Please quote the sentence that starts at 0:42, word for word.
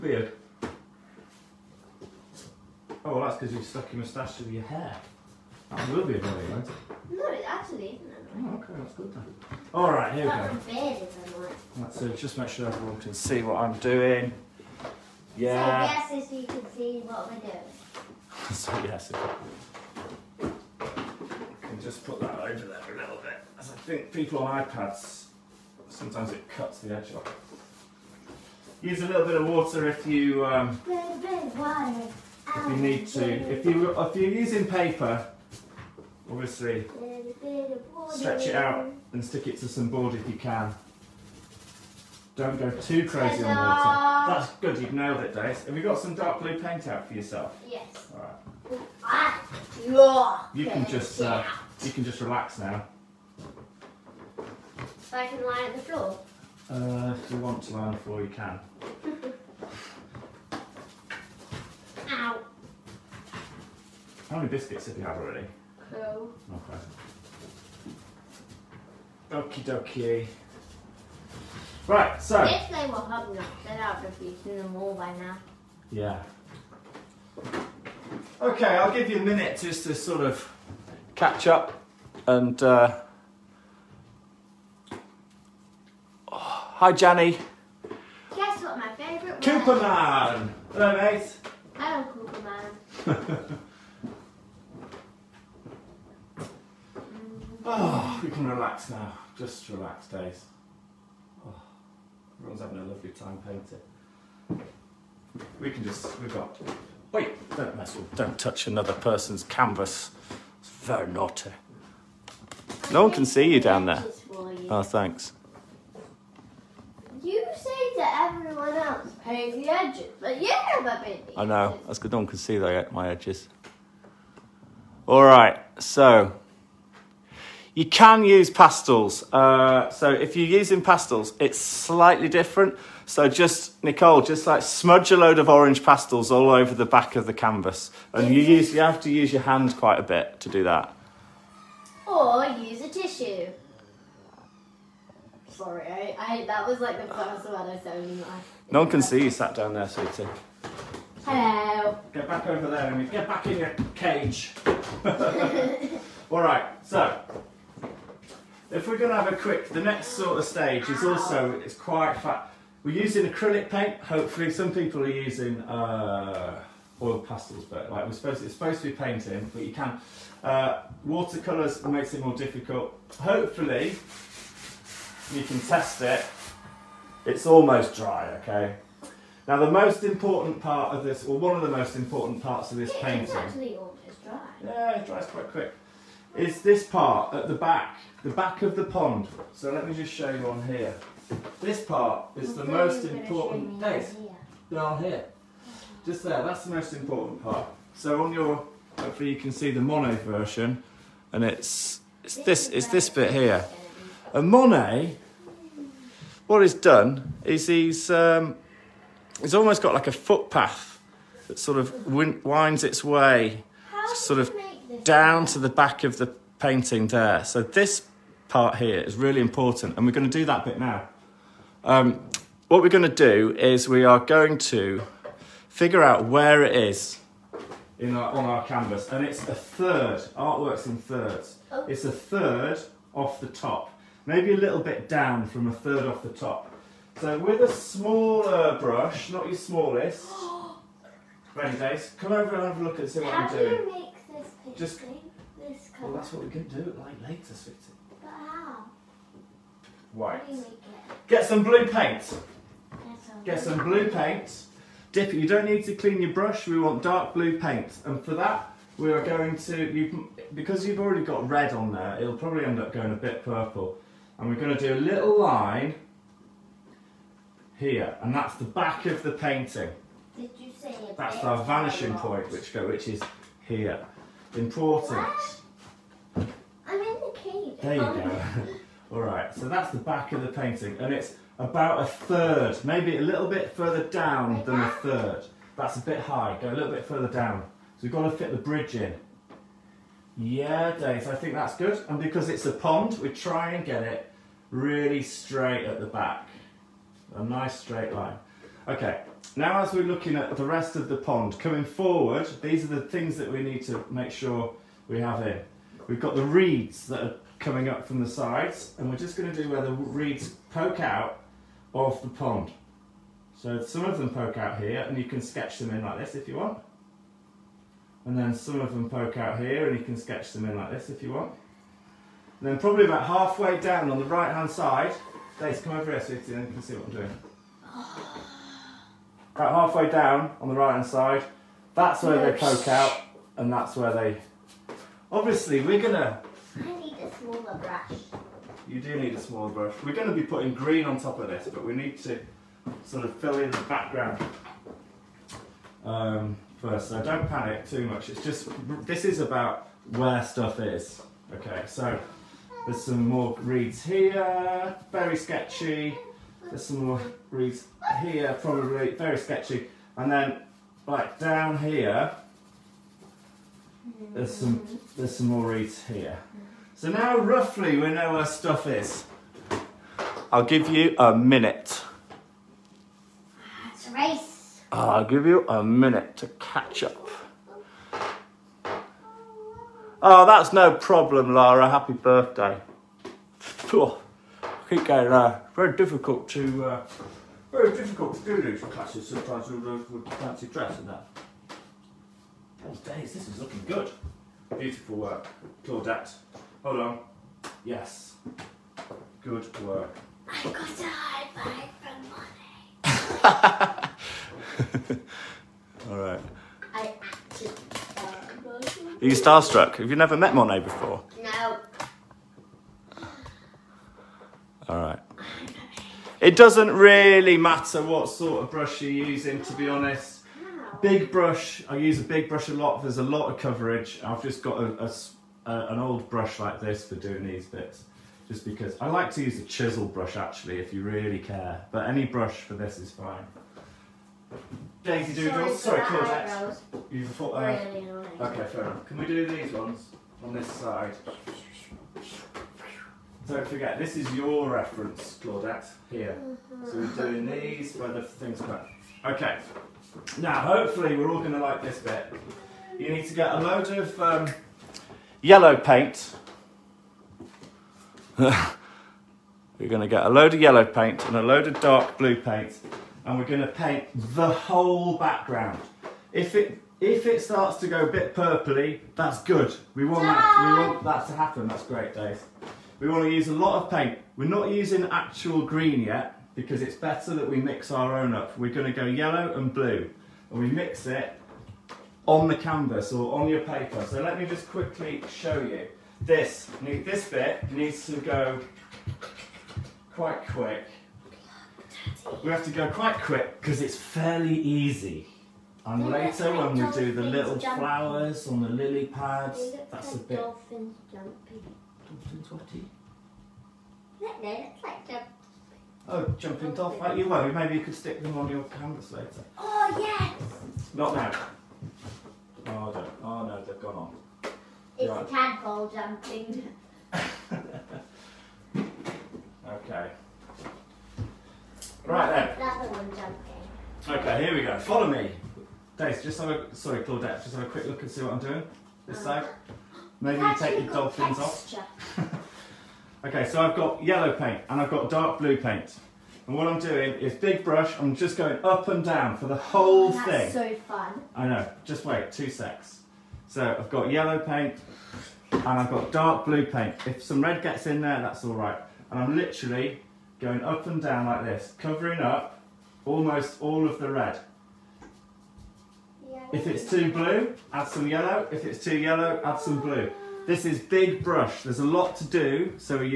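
Don't go too crazy on water.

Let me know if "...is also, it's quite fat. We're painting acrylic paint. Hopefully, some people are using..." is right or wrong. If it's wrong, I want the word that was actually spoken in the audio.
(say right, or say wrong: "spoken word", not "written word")
wrong: "using", not "painting".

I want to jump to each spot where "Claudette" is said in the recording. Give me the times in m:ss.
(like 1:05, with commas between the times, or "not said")
6:35, 7:16, 7:25, 8:47.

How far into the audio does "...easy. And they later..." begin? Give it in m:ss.
8:14.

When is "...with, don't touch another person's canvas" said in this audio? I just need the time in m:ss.
1:47.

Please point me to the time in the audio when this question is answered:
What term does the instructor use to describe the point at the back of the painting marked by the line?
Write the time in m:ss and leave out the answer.
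4:31.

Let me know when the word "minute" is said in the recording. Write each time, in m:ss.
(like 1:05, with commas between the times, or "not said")
1:19, 6:11, 6:15.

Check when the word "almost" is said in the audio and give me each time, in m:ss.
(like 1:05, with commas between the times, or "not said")
2:57, 3:03, 3:29, 9:13.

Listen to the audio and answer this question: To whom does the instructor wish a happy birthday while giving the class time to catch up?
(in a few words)
Lara.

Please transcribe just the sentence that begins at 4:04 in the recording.
Just, well, that's what we can do like later, sweetie.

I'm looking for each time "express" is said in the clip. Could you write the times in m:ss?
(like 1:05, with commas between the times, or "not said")
not said.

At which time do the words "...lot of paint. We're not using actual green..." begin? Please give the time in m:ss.
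7:53.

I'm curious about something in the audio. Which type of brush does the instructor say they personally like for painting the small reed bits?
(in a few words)
Chisel brush.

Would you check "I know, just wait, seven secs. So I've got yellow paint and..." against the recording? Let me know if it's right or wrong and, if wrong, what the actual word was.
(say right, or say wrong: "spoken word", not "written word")
wrong: "two", not "seven".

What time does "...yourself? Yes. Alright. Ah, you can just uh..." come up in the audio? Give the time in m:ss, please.
0:47.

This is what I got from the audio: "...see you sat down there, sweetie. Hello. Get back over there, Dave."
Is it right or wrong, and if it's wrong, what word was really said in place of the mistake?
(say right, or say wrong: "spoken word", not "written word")
wrong: "Amy", not "Dave".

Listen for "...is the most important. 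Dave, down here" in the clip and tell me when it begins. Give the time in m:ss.
3:12.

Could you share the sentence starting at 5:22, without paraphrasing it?
And then probably about halfway down on the right hand side, Daisy, come over here so you can see what I'm doing.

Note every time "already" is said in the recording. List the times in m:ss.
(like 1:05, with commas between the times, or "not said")
1:05, 4:20.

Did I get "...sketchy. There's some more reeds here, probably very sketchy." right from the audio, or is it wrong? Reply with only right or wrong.
right.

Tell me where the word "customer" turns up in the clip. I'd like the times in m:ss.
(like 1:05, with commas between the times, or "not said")
not said.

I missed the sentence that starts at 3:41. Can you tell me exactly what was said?
Um, what we're going to do is we are going to figure out where it is in our, on our canvas.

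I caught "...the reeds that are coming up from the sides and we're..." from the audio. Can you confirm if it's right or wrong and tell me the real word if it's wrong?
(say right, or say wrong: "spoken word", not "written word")
right.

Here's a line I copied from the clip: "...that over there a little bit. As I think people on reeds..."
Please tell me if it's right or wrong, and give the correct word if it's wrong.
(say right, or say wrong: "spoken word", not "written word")
wrong: "iPads", not "reeds".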